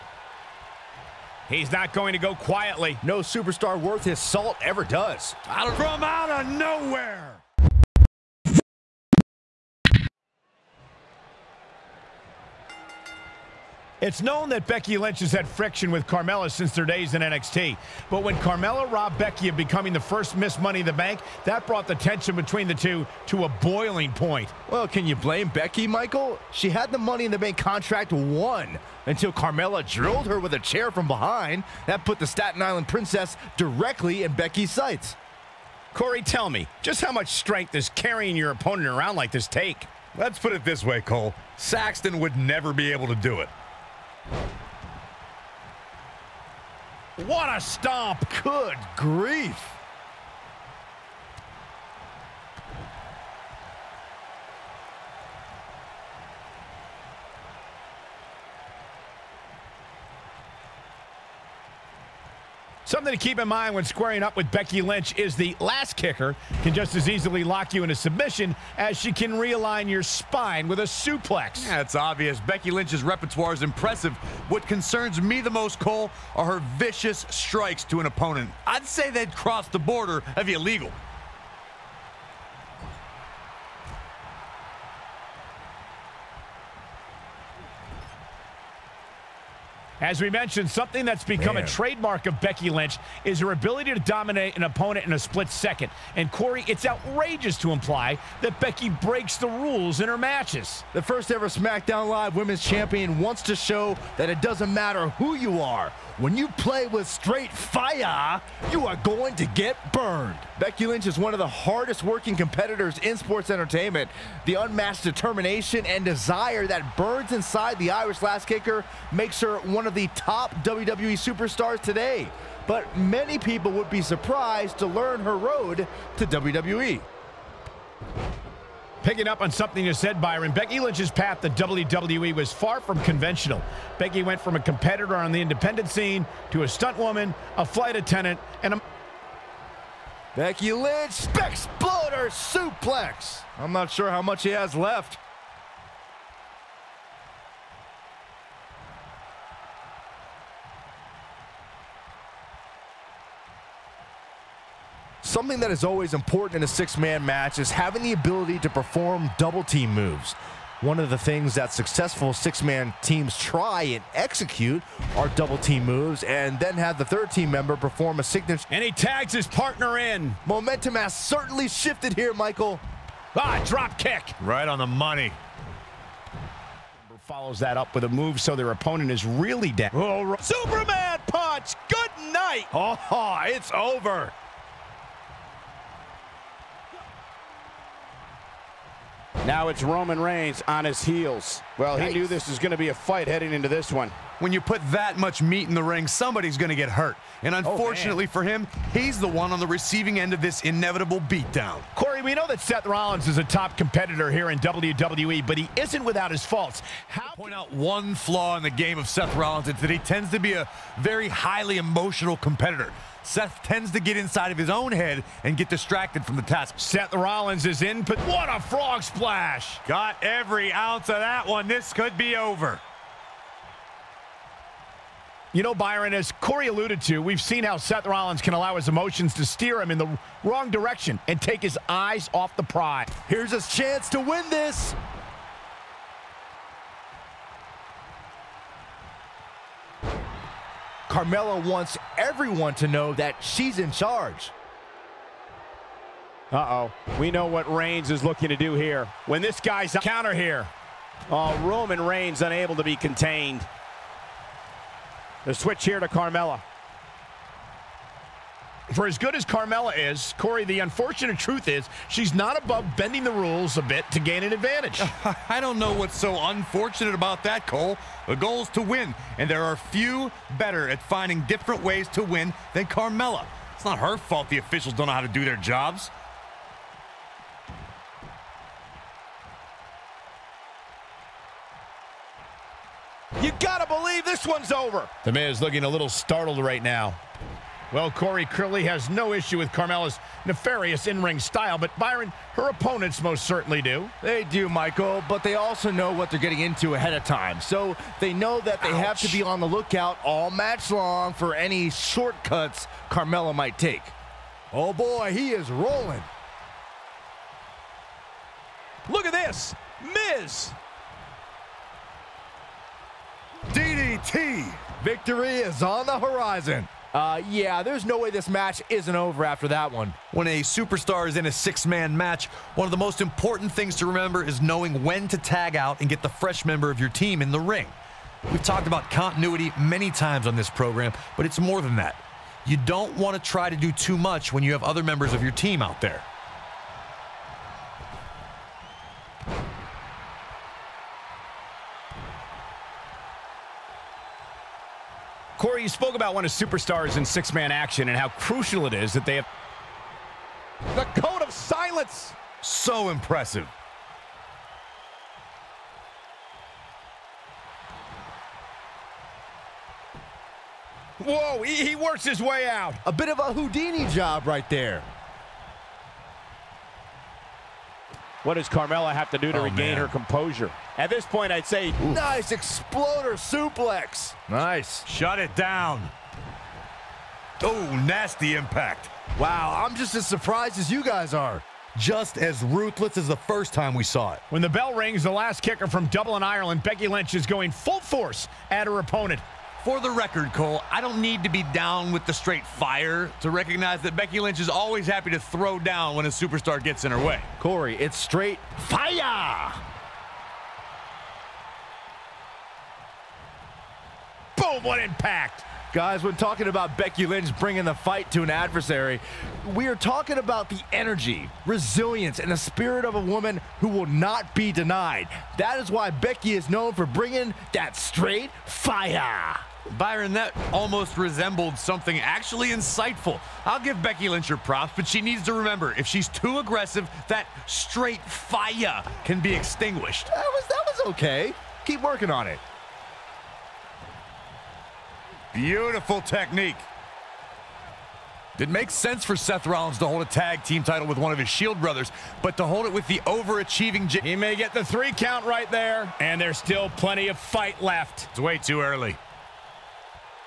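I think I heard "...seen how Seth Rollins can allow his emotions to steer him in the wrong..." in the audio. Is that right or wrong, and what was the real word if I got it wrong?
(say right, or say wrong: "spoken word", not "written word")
right.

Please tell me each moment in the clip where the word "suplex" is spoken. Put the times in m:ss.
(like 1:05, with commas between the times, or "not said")
1:10, 2:22, 6:13.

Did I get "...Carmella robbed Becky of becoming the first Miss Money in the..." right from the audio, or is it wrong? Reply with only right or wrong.
right.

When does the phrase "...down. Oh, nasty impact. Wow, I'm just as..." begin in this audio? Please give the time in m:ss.
6:15.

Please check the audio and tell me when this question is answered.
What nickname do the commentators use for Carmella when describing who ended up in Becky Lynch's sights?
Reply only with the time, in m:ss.
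0:32.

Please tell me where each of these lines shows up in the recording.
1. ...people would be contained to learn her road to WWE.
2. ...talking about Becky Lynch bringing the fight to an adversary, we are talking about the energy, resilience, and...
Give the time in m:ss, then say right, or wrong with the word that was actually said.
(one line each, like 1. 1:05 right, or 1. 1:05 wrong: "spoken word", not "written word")
1. 2:03 wrong: "surprised", not "contained"
2. 6:46 right.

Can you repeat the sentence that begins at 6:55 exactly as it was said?
That is why Becky is known for bringing that straight fire.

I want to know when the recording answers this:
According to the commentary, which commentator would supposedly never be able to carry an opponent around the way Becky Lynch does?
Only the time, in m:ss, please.
0:41.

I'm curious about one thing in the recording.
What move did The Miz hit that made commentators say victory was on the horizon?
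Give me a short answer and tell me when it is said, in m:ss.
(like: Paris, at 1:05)
DDT, at 5:13.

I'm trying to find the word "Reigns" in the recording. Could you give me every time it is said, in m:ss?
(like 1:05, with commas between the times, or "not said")
3:10, 4:07, 4:11.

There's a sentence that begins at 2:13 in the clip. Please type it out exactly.
Becky went from a competitor on the independent scene to a stunt woman, a flight attendant, and a...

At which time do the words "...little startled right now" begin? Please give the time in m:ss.
4:45.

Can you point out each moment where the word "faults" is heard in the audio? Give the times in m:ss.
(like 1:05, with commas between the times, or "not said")
3:26, 4:34.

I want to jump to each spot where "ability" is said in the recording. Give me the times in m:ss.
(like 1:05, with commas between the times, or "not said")
1:33, 2:38.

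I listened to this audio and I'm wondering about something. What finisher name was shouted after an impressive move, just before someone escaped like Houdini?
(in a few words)
The code of silence.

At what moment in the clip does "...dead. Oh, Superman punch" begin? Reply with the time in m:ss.
2:59.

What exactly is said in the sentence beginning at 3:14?
When you put that much meat in the ring, somebody's going to get hurt.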